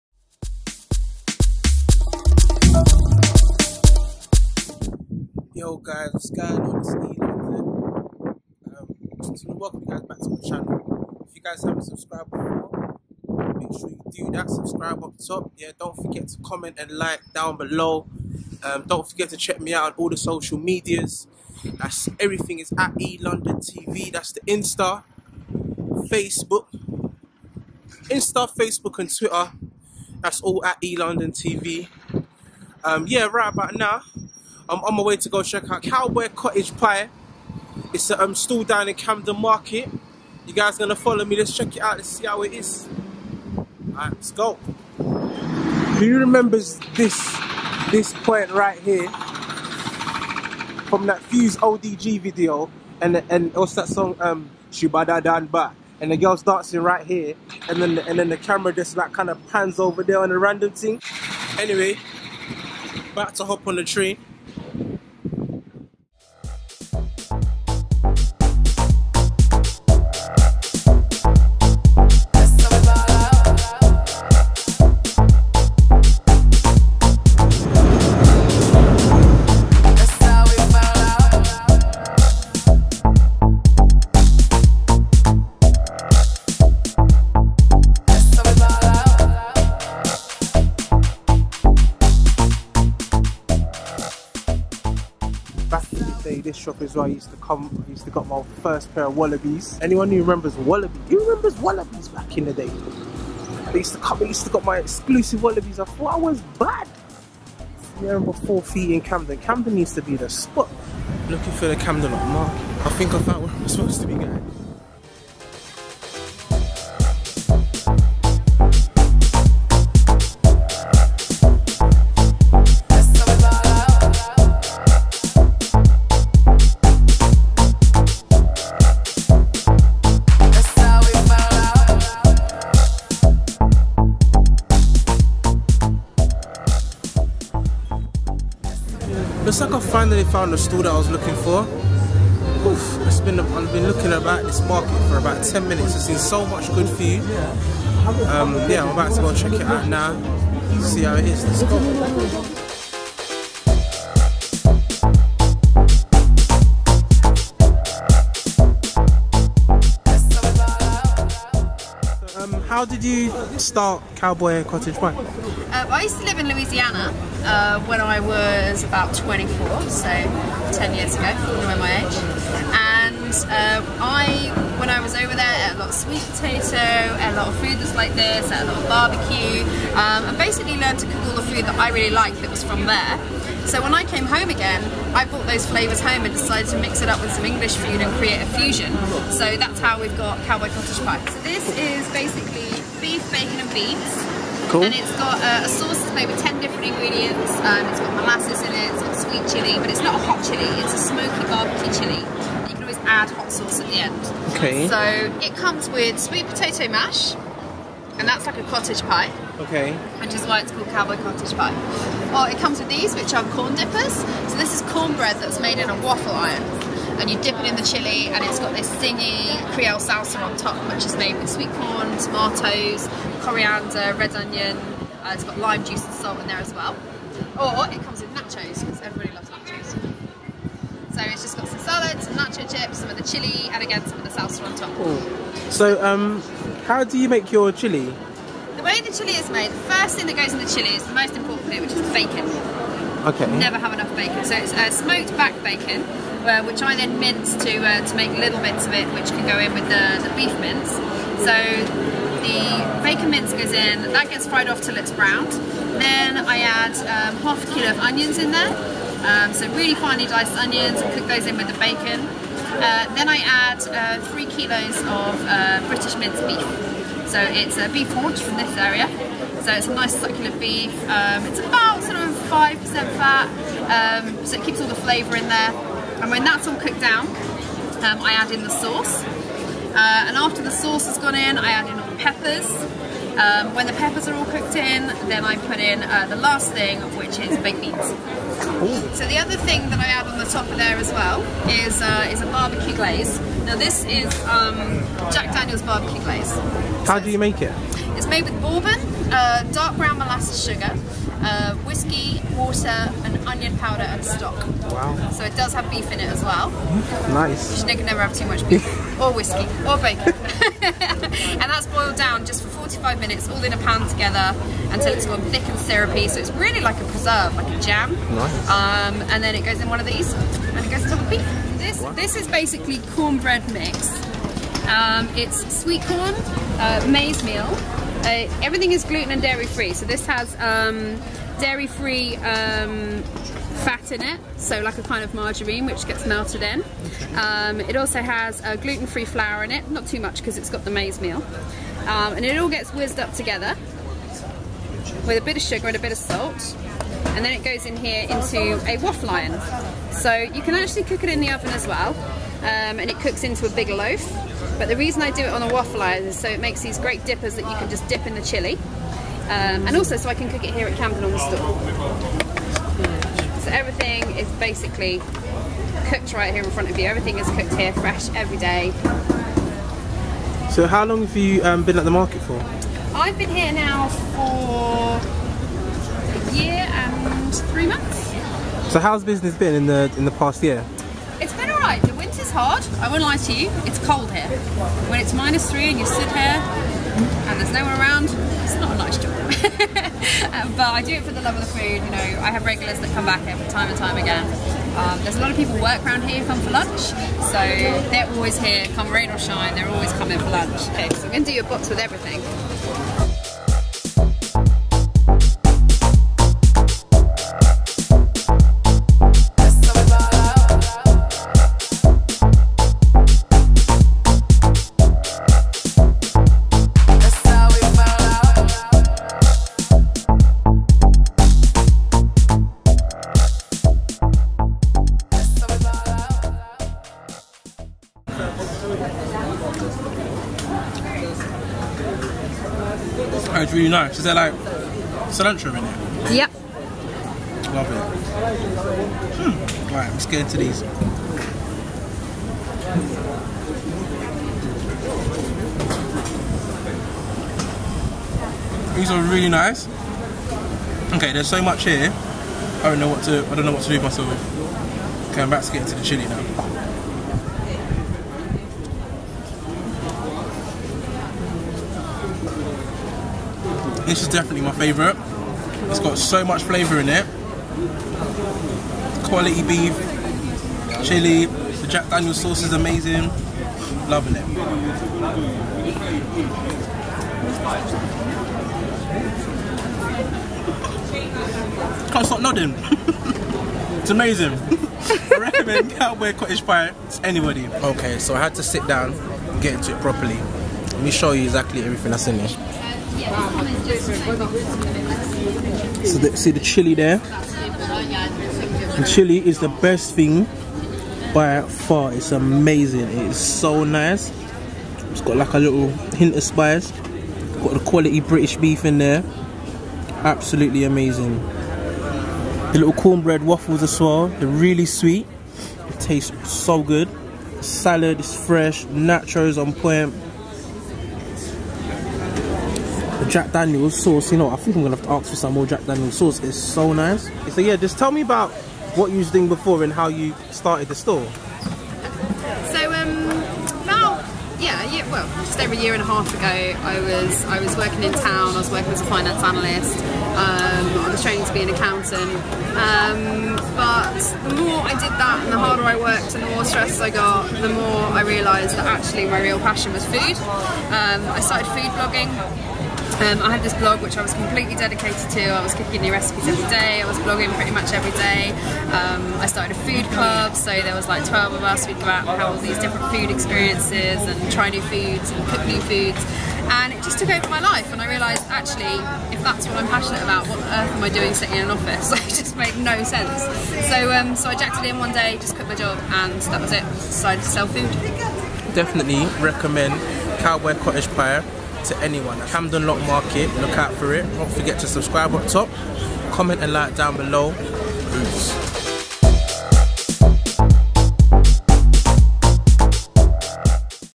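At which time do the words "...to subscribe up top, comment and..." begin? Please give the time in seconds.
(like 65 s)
584 s.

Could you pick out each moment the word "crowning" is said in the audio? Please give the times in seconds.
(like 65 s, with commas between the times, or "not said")
not said.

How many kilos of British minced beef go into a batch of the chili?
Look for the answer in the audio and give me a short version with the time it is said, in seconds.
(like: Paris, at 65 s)
3, at 264 s.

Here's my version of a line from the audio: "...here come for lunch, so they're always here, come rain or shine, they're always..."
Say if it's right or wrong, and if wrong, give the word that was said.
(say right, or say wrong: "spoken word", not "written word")
right.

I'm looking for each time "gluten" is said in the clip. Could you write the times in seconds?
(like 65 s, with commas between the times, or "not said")
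329 s, 338 s.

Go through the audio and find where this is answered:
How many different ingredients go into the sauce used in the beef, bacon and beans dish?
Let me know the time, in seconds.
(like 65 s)
196 s.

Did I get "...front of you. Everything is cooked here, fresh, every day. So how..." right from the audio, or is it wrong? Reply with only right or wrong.
right.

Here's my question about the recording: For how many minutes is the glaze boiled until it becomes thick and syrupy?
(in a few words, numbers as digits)
45.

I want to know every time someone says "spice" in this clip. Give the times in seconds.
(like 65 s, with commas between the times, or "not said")
506 s.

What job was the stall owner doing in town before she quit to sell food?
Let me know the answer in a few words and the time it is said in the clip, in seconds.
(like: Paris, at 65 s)
Finance analyst, at 539 s.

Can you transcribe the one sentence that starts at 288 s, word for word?
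So the other thing that I add on the top of there as well is uh, is a barbecue glaze.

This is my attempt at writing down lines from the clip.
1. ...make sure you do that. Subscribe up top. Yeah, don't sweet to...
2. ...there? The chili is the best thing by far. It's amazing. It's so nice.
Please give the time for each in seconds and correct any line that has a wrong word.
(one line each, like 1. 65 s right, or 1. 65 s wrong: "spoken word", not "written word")
1. 13 s wrong: "forget", not "sweet"
2. 496 s right.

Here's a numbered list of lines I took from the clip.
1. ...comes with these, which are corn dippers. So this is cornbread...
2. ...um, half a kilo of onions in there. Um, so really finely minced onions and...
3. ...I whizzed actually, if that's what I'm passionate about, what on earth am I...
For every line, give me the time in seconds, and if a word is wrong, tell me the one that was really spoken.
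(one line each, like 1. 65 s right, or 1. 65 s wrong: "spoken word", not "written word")
1. 212 s right
2. 257 s wrong: "diced", not "minced"
3. 568 s wrong: "realised", not "whizzed".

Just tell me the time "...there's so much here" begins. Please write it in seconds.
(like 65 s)
451 s.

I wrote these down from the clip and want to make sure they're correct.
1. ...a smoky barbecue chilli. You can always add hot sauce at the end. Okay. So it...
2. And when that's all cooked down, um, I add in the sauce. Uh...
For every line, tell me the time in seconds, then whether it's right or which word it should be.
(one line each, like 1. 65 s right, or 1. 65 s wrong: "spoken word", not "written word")
1. 200 s right
2. 276 s right.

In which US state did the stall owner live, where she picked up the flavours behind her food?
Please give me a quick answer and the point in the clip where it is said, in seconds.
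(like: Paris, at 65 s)
Louisiana, at 166 s.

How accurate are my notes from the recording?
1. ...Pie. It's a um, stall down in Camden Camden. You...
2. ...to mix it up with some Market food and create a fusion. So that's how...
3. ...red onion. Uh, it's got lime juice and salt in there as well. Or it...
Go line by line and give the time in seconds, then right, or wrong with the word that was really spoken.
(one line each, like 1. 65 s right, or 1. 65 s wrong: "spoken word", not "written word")
1. 36 s wrong: "Market", not "Camden"
2. 186 s wrong: "English", not "Market"
3. 224 s right.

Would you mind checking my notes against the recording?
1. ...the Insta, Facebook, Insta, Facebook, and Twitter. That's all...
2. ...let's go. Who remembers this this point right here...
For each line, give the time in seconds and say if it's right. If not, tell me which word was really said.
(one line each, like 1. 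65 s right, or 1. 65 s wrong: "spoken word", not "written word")
1. 24 s right
2. 44 s right.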